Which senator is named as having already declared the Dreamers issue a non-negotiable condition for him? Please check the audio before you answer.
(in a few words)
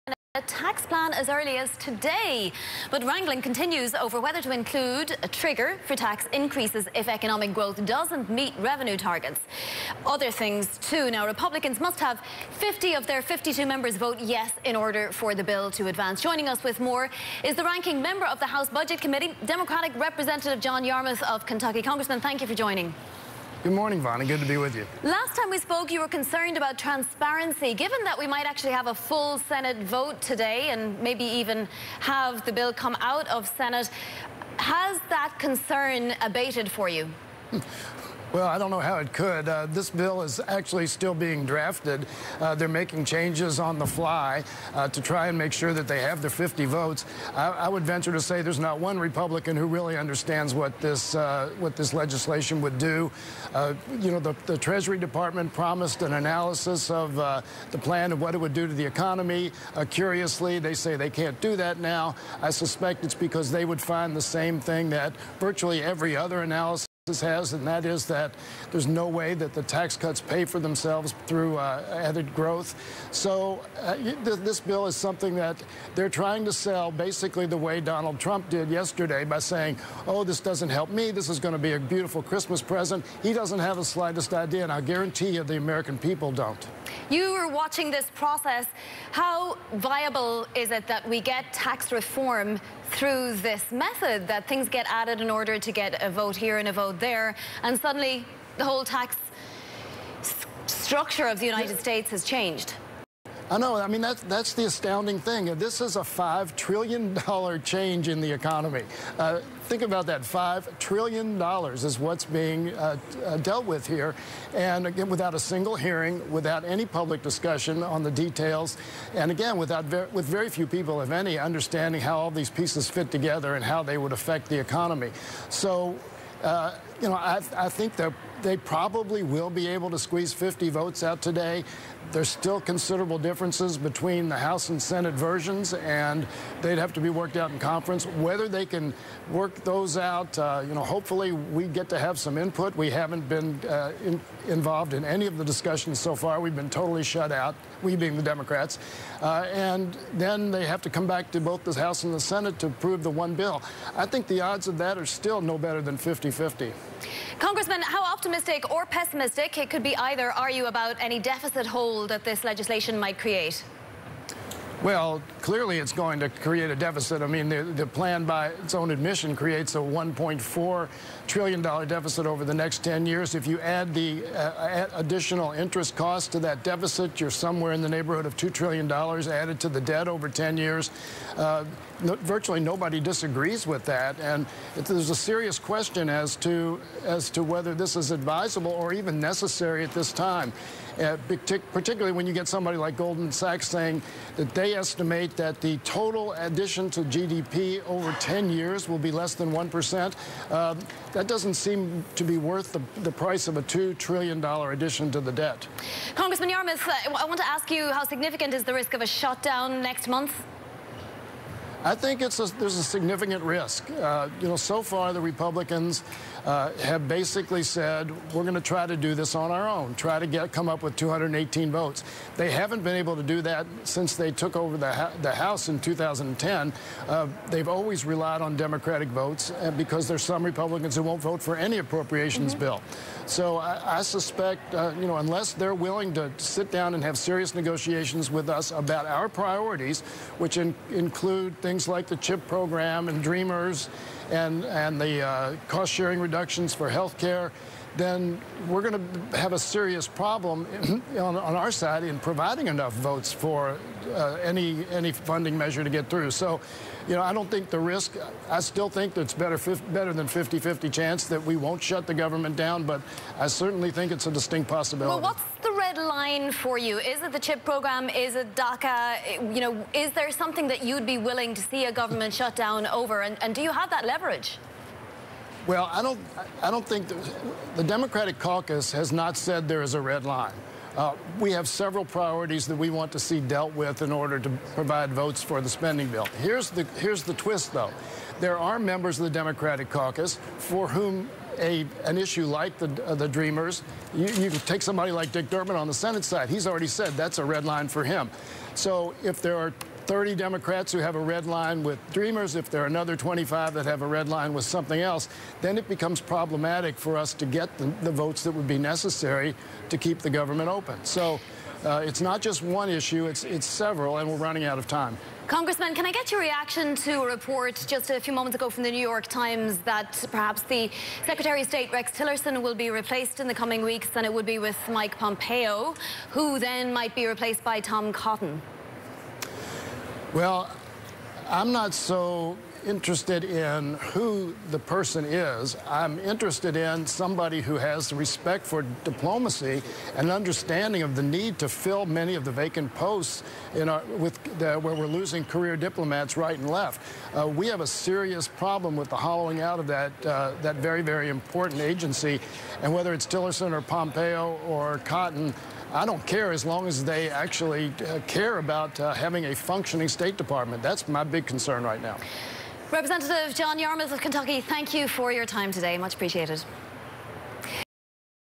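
Dick Durbin.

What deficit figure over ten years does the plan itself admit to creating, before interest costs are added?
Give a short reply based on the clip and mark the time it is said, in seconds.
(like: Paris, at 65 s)
$1.4 trillion, at 169 s.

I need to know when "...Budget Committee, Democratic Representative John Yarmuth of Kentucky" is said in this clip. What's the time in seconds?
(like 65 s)
18 s.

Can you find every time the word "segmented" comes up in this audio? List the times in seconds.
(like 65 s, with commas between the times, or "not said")
not said.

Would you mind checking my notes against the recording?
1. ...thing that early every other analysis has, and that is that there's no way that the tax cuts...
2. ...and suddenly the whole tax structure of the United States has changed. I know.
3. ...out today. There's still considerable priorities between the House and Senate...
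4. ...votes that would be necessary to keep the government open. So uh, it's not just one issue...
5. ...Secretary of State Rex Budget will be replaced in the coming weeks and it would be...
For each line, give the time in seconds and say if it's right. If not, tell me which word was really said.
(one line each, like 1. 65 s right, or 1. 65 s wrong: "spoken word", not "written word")
1. 64 s wrong: "virtually", not "early"
2. 97 s right
3. 131 s wrong: "differences", not "priorities"
4. 308 s right
5. 321 s wrong: "Tillerson", not "Budget".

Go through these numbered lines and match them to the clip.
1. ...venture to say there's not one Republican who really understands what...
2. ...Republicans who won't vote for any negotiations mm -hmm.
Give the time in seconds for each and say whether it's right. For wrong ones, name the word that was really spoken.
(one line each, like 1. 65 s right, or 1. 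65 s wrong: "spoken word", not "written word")
1. 47 s right
2. 230 s wrong: "appropriations", not "negotiations".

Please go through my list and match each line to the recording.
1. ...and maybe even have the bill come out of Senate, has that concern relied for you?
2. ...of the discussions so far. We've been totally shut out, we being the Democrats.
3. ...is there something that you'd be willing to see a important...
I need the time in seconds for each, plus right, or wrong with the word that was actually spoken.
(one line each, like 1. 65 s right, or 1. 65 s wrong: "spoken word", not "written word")
1. 30 s wrong: "abated", not "relied"
2. 145 s right
3. 269 s wrong: "government", not "important".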